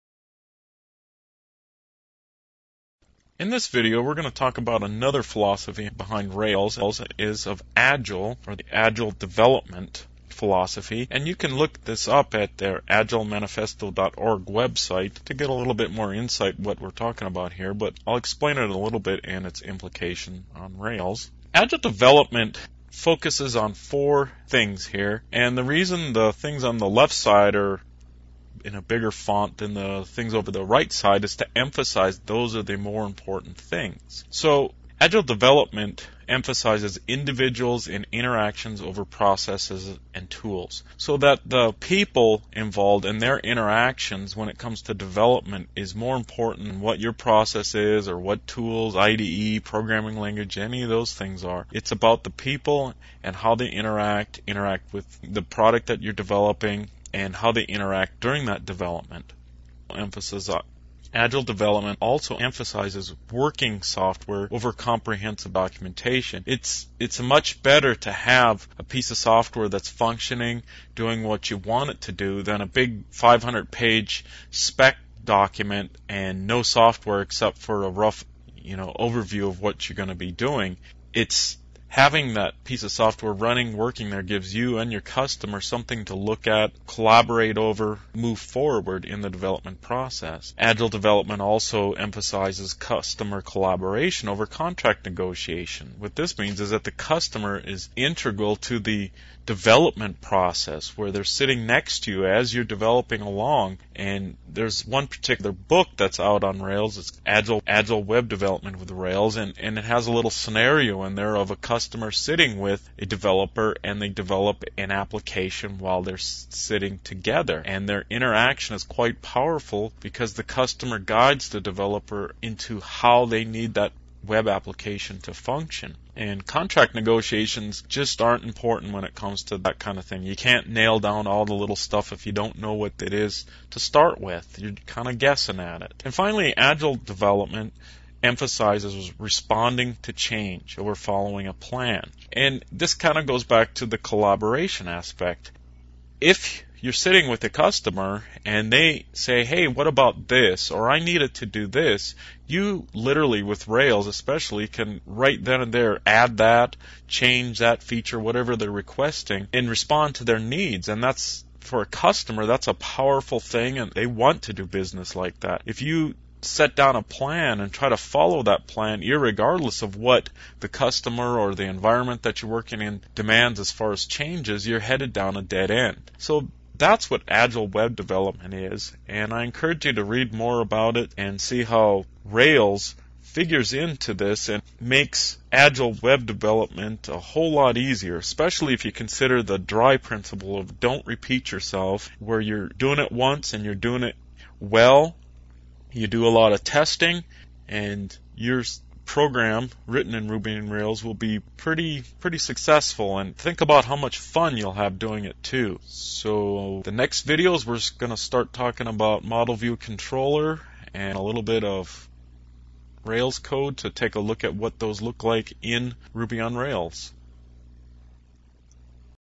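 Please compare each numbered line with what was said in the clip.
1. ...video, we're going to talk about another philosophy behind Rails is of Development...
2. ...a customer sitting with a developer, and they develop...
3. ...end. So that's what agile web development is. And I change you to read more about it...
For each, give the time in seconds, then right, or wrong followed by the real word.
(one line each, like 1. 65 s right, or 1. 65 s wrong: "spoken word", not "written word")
1. 3 s wrong: "Agile", not "Development"
2. 111 s right
3. 175 s wrong: "encourage", not "change".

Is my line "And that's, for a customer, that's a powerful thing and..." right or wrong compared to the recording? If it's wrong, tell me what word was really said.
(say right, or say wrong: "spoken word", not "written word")
right.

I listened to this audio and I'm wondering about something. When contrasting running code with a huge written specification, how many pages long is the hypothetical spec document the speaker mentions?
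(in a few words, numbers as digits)
500.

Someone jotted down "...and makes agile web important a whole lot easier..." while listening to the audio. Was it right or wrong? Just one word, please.
wrong.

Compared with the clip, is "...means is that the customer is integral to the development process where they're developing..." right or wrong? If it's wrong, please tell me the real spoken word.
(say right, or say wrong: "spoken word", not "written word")
wrong: "sitting", not "developing".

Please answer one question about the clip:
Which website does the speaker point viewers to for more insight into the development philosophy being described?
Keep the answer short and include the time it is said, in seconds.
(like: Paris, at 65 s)
agilemanifesto.org, at 12 s.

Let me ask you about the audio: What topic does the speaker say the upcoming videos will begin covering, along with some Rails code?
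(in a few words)
Model view controller.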